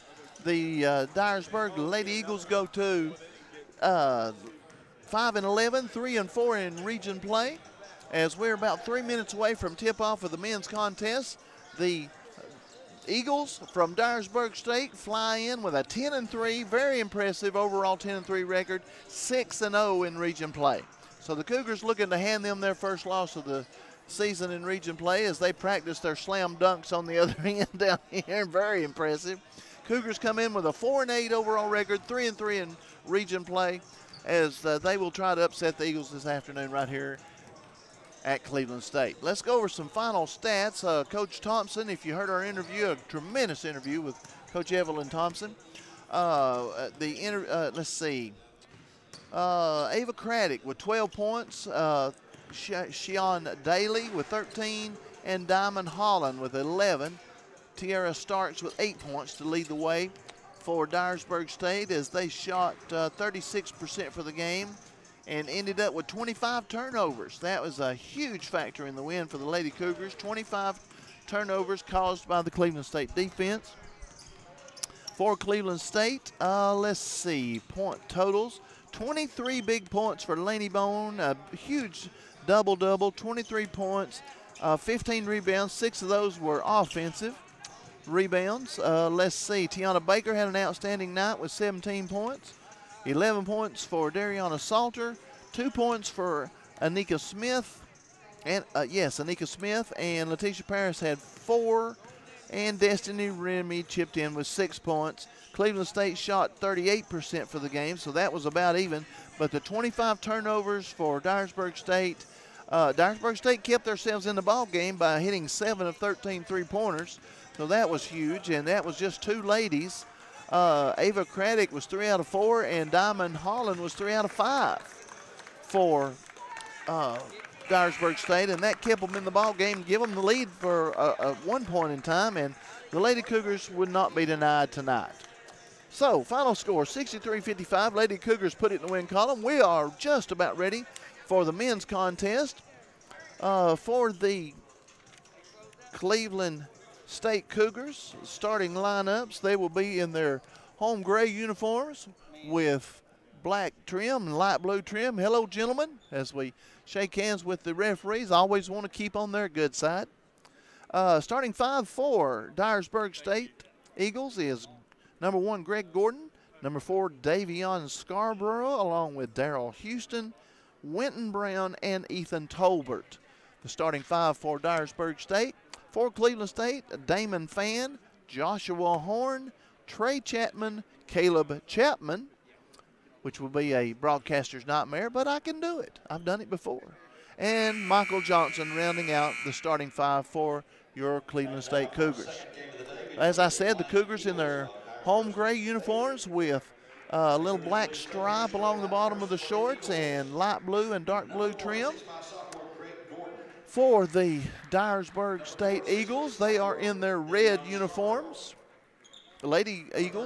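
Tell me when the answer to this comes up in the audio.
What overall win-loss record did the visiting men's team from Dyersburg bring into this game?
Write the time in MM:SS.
00:15.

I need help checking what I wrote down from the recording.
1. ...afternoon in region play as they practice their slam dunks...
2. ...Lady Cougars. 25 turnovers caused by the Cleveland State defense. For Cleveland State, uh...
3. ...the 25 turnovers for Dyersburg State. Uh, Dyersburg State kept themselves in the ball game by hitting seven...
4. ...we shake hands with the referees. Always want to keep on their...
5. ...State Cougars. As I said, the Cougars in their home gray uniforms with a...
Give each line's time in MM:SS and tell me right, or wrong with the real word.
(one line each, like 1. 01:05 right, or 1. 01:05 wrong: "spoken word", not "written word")
1. 00:24 wrong: "season", not "afternoon"
2. 01:09 right
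3. 01:49 right
4. 02:36 right
5. 03:11 right.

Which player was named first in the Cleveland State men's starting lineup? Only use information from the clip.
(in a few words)
Damon Fan.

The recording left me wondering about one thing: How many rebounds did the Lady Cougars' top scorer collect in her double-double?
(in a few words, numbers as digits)
15.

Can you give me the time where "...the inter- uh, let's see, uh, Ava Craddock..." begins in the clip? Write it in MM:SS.
00:46.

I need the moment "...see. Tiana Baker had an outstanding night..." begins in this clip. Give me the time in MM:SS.
01:29.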